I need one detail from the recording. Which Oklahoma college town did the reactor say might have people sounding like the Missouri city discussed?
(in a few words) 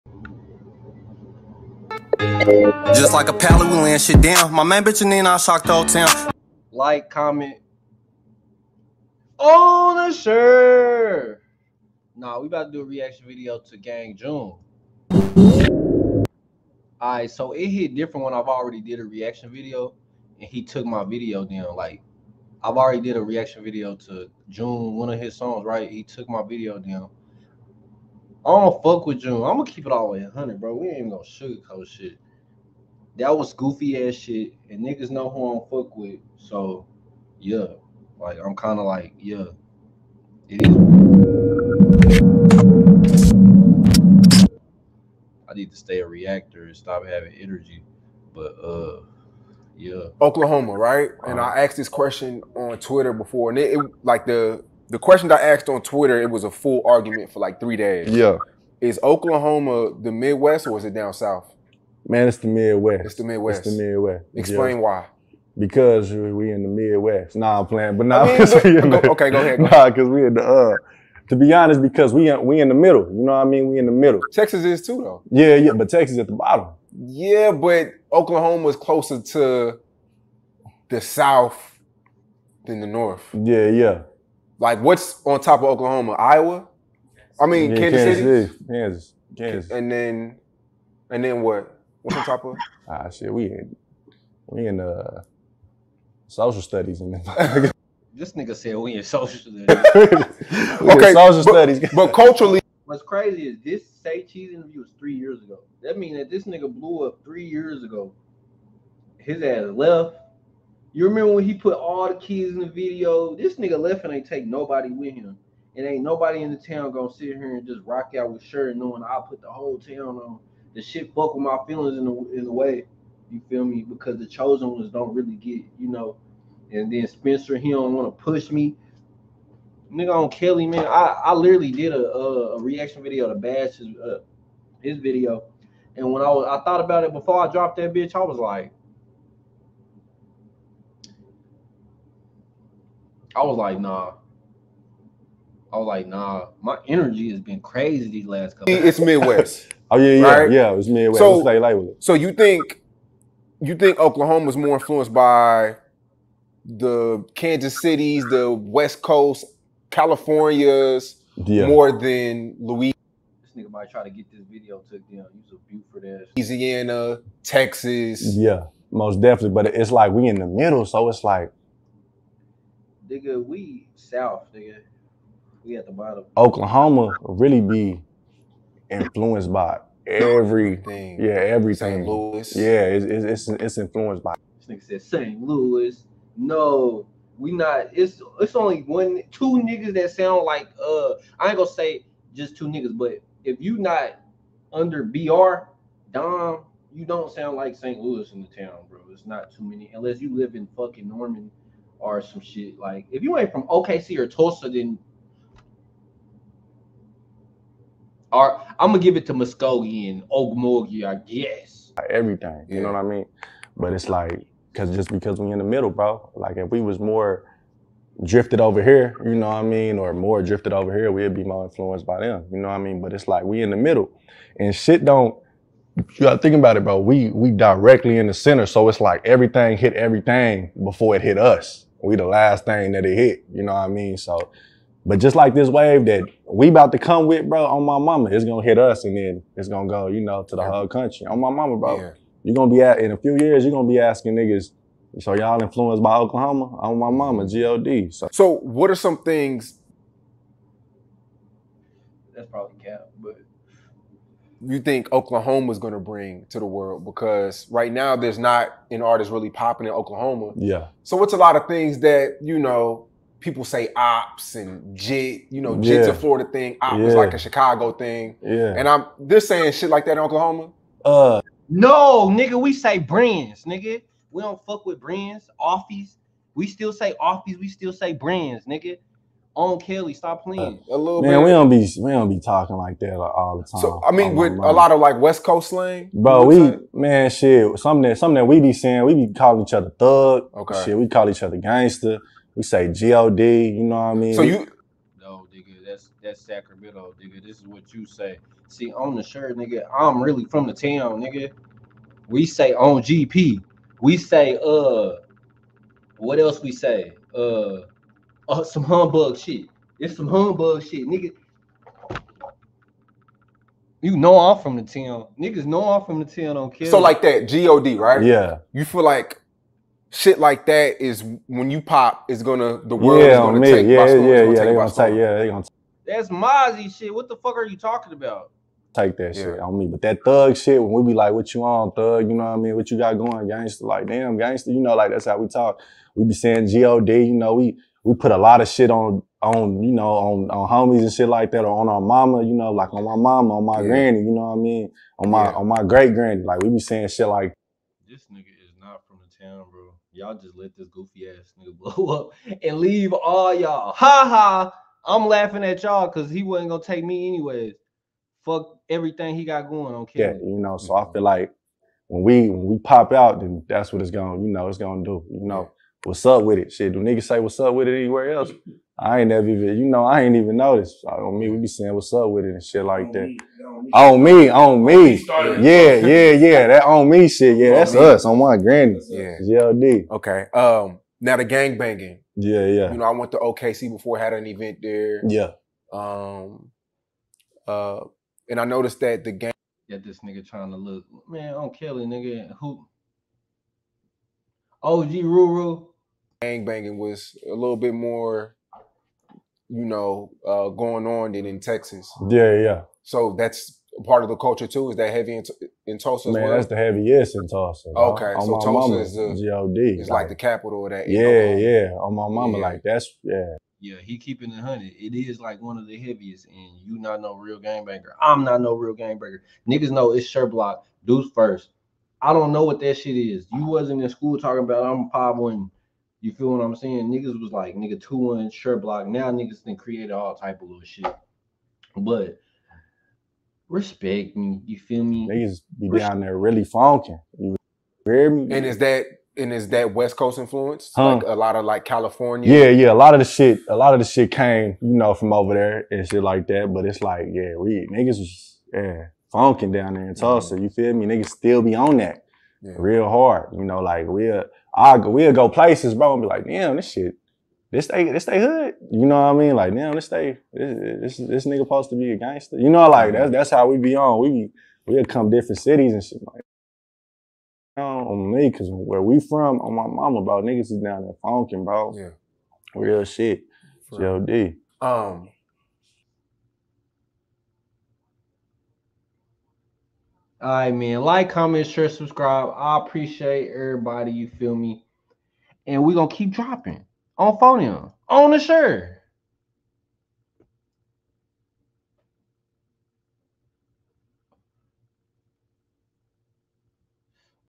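Norman.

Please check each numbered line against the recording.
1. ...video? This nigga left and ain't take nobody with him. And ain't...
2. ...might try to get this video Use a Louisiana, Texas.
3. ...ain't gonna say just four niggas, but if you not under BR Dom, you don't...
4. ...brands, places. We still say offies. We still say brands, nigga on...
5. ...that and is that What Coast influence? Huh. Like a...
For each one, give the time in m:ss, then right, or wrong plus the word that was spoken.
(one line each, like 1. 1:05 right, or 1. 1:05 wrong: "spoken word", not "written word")
1. 1:52 right
2. 2:43 right
3. 3:11 wrong: "two", not "four"
4. 4:34 wrong: "offies", not "places"
5. 7:18 wrong: "West", not "What".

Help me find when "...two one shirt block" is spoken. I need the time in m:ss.
7:08.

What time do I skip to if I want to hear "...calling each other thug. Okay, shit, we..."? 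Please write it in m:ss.
4:49.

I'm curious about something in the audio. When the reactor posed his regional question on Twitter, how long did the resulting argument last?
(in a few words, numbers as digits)
3 days.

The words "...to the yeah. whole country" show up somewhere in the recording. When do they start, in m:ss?
4:00.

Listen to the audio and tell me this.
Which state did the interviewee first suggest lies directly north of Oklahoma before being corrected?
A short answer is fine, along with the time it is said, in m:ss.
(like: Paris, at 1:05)
Iowa, at 1:26.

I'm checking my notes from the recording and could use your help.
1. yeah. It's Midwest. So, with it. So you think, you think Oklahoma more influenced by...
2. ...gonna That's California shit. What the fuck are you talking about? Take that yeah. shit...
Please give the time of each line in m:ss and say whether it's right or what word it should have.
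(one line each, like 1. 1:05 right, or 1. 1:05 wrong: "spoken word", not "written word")
1. 2:30 right
2. 5:25 wrong: "Mozzy", not "California".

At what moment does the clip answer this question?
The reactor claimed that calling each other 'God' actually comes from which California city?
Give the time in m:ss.
4:56.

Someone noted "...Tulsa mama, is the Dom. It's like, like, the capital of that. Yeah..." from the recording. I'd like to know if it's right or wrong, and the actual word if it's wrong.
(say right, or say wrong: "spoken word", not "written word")
wrong: "God", not "Dom".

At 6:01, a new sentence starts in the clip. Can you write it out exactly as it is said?
feel like when we when we pop out, then that's what it's gonna you know it's gonna do.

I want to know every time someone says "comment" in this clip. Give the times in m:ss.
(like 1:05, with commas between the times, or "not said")
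0:07, 8:01.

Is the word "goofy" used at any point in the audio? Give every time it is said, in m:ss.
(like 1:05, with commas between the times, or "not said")
0:33, 5:50.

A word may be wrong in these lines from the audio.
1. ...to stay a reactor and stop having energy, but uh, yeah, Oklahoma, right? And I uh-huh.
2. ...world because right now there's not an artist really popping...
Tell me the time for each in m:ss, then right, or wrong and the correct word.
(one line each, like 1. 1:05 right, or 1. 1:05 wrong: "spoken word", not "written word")
1. 0:45 right
2. 4:16 right.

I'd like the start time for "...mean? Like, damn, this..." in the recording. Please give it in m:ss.
7:39.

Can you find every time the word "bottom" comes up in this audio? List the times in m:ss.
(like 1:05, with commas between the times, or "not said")
1:16, 2:55.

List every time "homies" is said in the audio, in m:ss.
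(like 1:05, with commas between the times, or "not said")
5:40.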